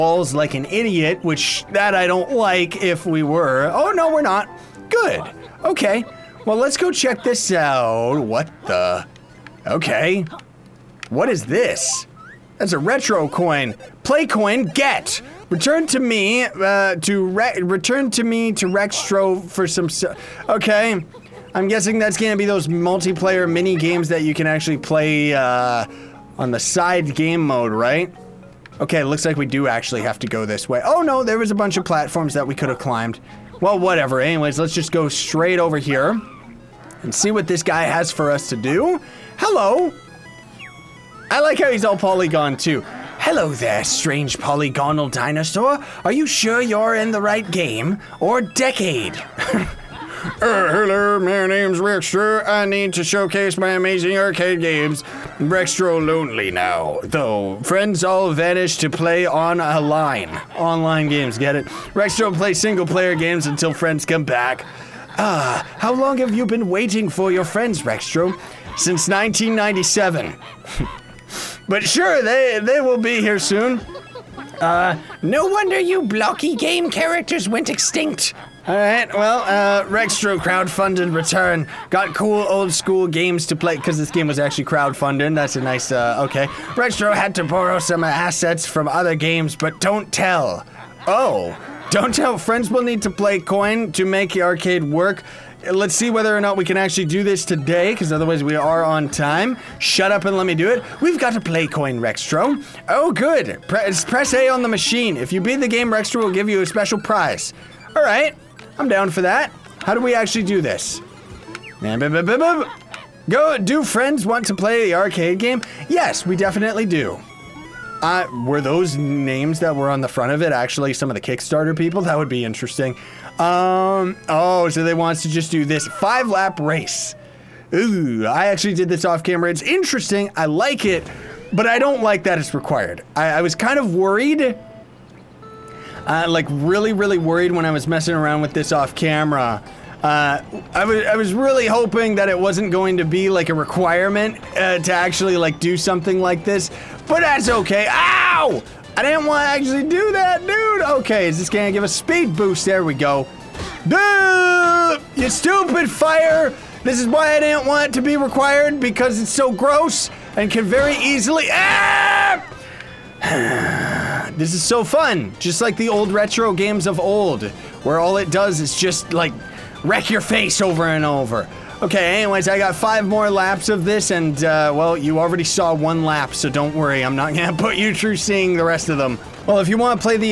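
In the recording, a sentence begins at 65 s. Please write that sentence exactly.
Ah, how long have you been waiting for your friends, Rextro?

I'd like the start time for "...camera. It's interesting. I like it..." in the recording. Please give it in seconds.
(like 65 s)
129 s.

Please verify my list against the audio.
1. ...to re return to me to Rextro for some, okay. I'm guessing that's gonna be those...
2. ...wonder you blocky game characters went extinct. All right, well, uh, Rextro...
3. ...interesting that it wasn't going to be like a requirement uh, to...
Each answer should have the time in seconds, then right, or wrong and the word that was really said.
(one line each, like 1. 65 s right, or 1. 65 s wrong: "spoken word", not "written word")
1. 16 s right
2. 75 s right
3. 141 s wrong: "hoping", not "interesting".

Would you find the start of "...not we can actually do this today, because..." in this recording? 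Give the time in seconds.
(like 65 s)
96 s.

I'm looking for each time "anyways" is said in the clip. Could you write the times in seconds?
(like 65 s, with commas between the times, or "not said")
34 s, 172 s.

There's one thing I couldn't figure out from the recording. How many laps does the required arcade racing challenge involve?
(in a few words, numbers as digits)
5.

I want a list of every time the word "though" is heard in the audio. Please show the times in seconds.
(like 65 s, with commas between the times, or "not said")
57 s.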